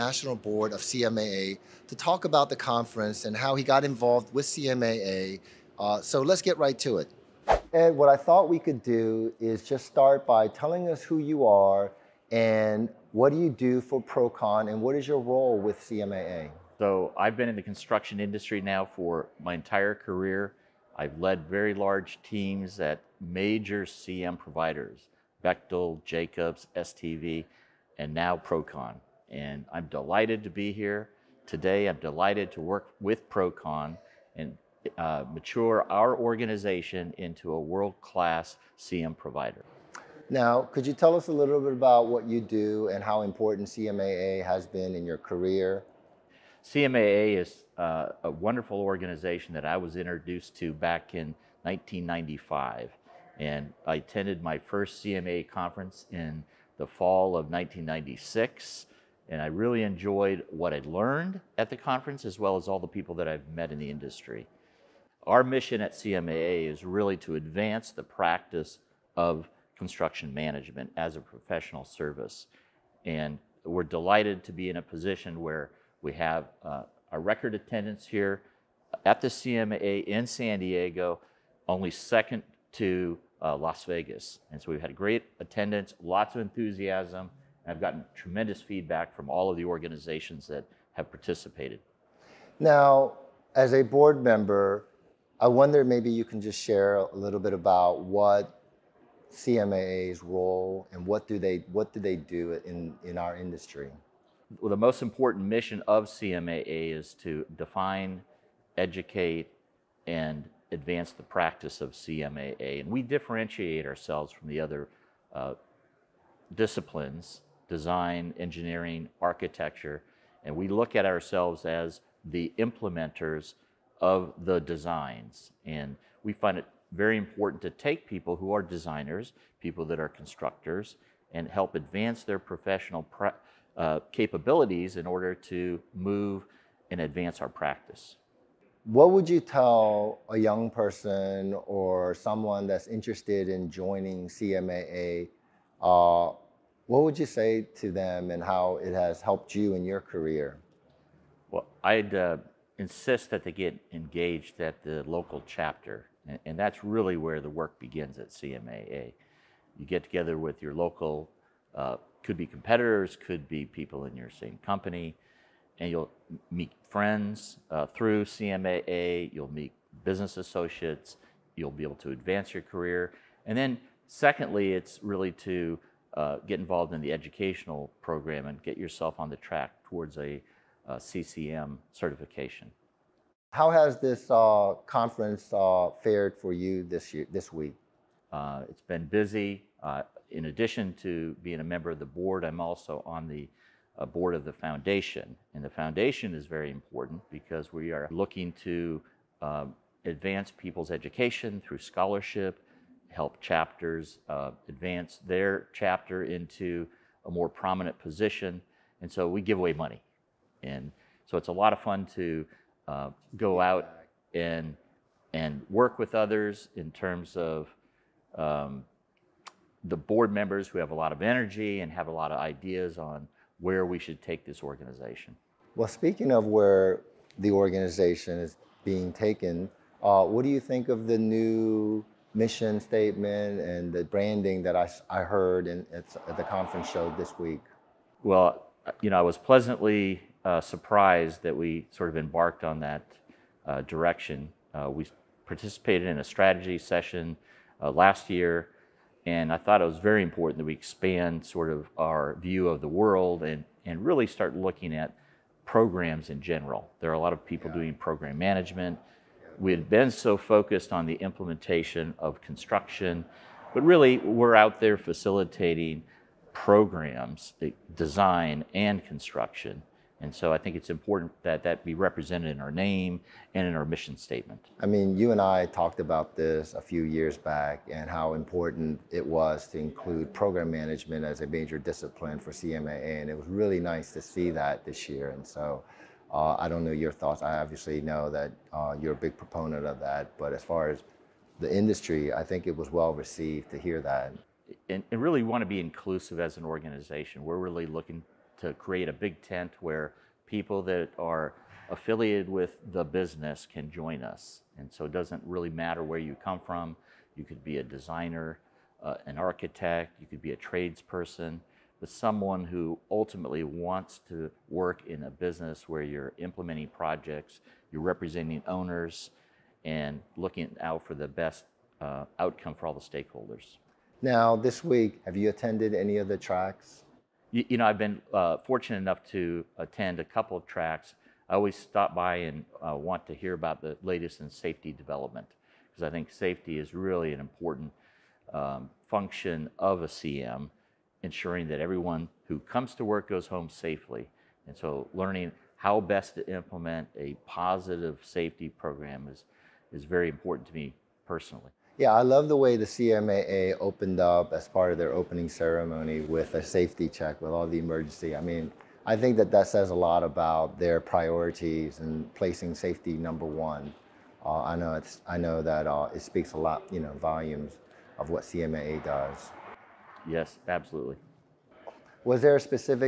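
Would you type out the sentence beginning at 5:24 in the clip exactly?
Now, this week, have you attended any of the tracks?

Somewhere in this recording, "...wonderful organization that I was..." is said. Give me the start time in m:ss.
0:48.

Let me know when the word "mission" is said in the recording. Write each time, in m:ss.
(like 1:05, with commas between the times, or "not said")
1:05, 1:45, 3:52, 4:33.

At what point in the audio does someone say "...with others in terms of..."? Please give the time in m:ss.
3:35.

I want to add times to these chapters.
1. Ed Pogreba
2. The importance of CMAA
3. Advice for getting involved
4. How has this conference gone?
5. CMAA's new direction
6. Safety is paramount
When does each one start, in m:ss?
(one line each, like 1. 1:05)
1. 0:07
2. 1:32
3. 2:18
4. 3:03
5. 3:45
6. 5:23.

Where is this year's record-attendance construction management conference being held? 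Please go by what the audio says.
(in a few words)
San Diego.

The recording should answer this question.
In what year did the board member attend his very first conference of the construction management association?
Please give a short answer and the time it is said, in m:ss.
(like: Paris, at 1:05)
1996, at 0:56.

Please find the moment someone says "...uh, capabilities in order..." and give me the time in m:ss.
2:13.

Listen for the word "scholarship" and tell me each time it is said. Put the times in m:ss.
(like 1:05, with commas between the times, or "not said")
3:21.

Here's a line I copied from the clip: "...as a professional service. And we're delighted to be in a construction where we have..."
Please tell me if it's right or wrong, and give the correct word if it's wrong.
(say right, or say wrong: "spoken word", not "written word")
wrong: "position", not "construction".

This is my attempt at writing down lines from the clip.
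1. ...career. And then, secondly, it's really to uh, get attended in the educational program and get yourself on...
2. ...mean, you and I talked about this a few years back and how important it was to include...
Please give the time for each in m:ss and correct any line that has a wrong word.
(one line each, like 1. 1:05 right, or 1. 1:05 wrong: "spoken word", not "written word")
1. 2:52 wrong: "involved", not "attended"
2. 4:34 right.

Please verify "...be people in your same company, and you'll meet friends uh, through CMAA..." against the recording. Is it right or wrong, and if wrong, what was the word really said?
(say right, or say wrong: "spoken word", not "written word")
right.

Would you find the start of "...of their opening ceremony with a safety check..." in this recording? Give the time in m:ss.
5:54.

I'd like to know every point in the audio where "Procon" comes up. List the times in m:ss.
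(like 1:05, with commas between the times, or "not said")
0:14, 0:28, 0:33.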